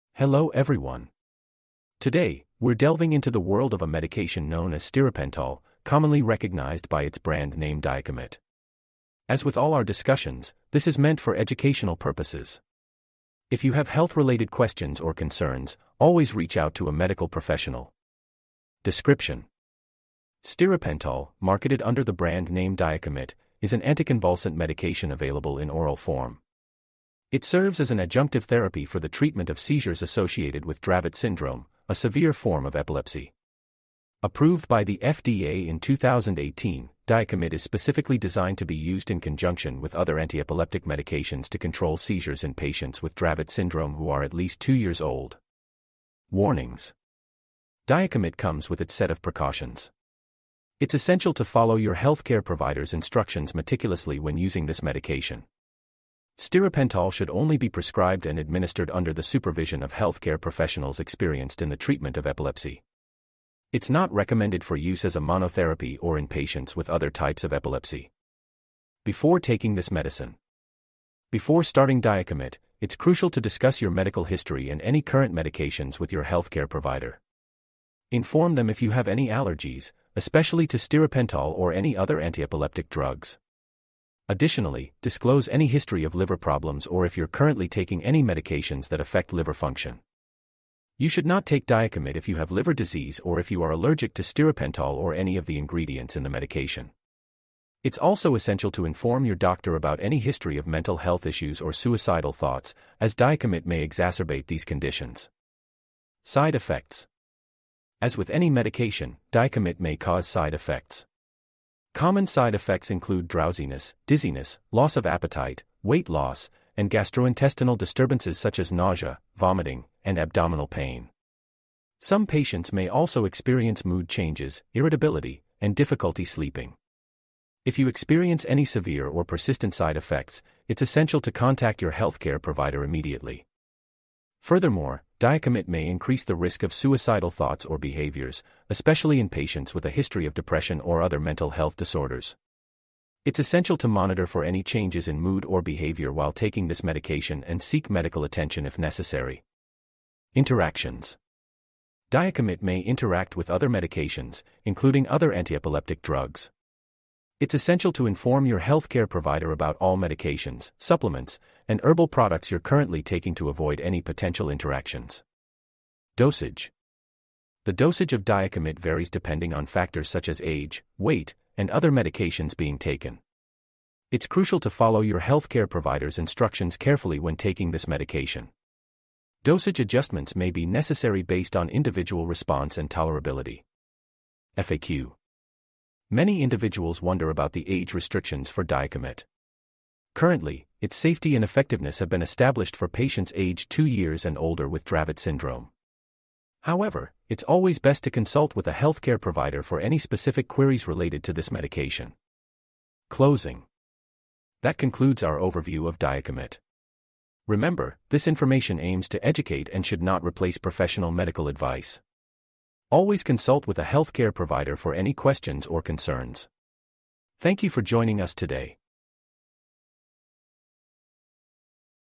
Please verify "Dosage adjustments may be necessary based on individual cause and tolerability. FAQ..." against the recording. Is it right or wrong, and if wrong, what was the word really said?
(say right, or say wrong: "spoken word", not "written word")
wrong: "response", not "cause".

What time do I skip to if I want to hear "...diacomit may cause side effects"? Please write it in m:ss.
1:49.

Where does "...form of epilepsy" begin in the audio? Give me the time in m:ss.
0:32.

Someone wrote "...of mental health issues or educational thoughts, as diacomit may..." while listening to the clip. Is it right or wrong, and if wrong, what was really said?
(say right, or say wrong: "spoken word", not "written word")
wrong: "suicidal", not "educational".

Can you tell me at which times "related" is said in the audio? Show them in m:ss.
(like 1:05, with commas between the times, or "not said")
0:13, 3:20.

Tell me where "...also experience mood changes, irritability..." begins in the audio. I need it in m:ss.
2:02.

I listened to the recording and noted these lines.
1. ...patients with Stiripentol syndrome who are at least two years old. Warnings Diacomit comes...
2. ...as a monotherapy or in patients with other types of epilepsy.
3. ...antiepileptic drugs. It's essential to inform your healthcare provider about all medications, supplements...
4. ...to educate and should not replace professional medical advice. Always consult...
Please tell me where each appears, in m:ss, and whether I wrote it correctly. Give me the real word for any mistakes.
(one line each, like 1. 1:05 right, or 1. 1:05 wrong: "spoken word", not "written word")
1. 0:42 wrong: "Dravet", not "Stiripentol"
2. 1:05 right
3. 2:35 right
4. 3:29 right.